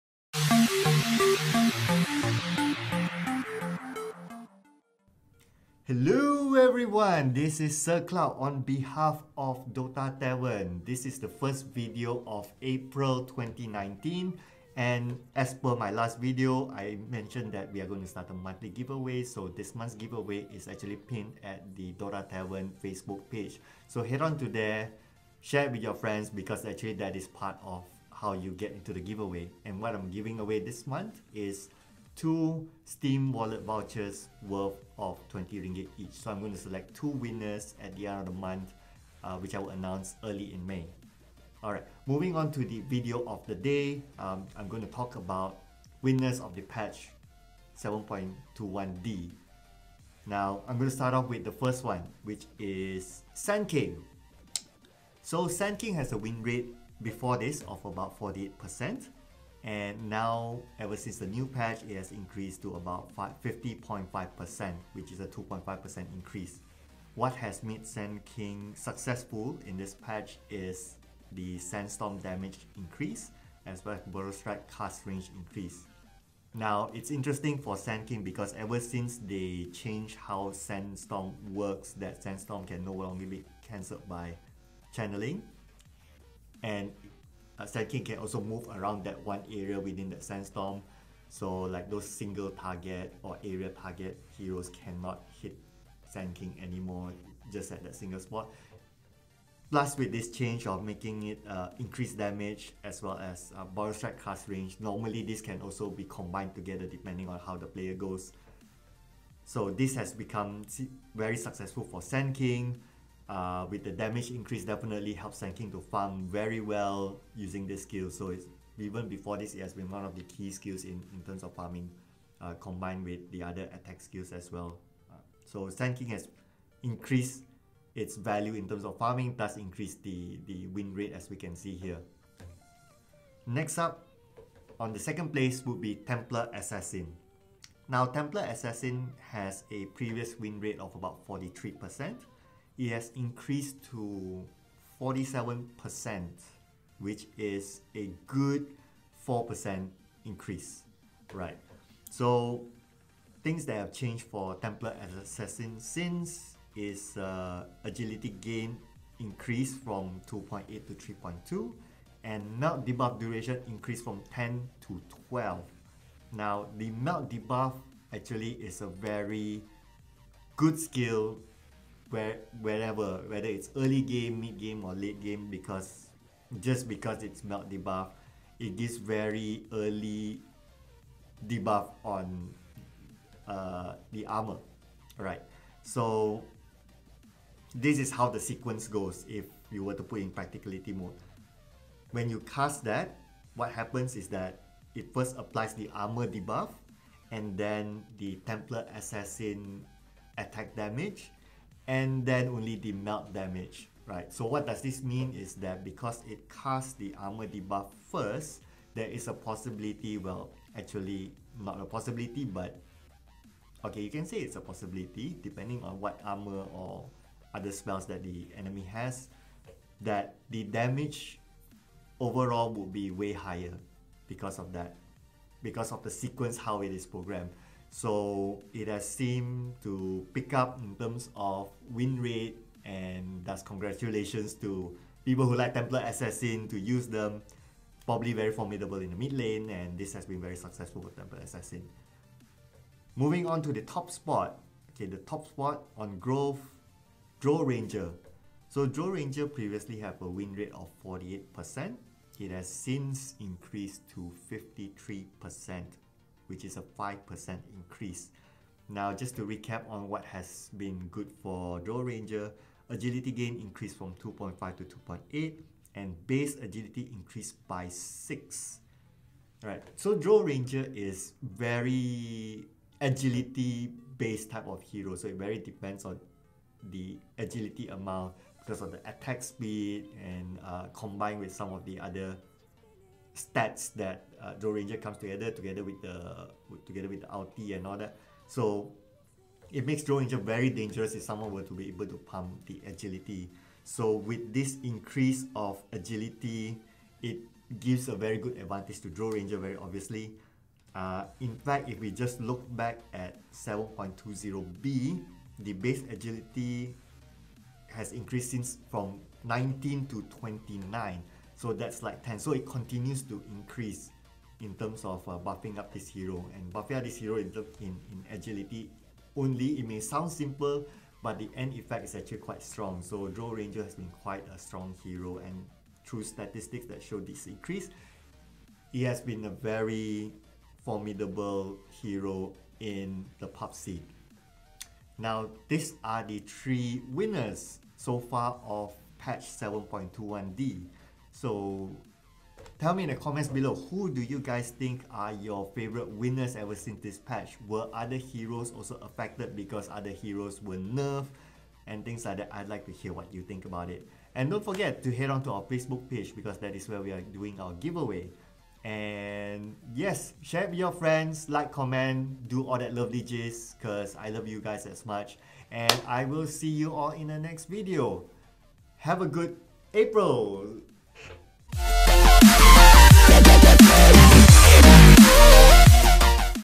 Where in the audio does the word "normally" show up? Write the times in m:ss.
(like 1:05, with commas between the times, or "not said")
1:44.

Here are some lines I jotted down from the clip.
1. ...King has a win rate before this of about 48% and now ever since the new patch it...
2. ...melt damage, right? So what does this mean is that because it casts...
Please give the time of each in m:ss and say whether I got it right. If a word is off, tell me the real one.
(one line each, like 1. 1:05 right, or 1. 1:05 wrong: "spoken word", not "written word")
1. 0:55 right
2. 3:22 right.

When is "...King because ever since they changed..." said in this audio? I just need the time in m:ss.
1:18.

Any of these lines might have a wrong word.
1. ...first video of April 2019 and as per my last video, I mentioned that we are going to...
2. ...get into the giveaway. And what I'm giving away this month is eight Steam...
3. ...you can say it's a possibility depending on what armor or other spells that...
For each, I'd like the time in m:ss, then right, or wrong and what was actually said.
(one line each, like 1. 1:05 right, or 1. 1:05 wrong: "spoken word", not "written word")
1. 0:11 right
2. 0:28 wrong: "two", not "eight"
3. 3:33 right.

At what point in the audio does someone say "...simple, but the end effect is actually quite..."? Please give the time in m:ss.
5:20.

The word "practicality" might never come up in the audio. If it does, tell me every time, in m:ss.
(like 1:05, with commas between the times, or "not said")
3:10.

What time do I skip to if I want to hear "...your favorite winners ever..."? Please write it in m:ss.
5:45.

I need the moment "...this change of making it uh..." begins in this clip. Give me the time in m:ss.
1:40.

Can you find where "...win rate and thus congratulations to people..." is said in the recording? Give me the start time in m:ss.
3:51.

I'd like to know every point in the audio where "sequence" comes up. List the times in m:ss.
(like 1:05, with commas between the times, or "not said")
3:08, 3:46.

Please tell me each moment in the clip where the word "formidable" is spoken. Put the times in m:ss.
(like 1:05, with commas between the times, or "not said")
3:58, 5:30.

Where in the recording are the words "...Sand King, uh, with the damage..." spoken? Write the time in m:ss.
1:52.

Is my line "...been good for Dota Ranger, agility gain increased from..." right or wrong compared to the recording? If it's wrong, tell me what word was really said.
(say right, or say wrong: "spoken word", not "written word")
wrong: "Drow", not "Dota".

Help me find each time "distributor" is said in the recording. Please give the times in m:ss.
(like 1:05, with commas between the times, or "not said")
not said.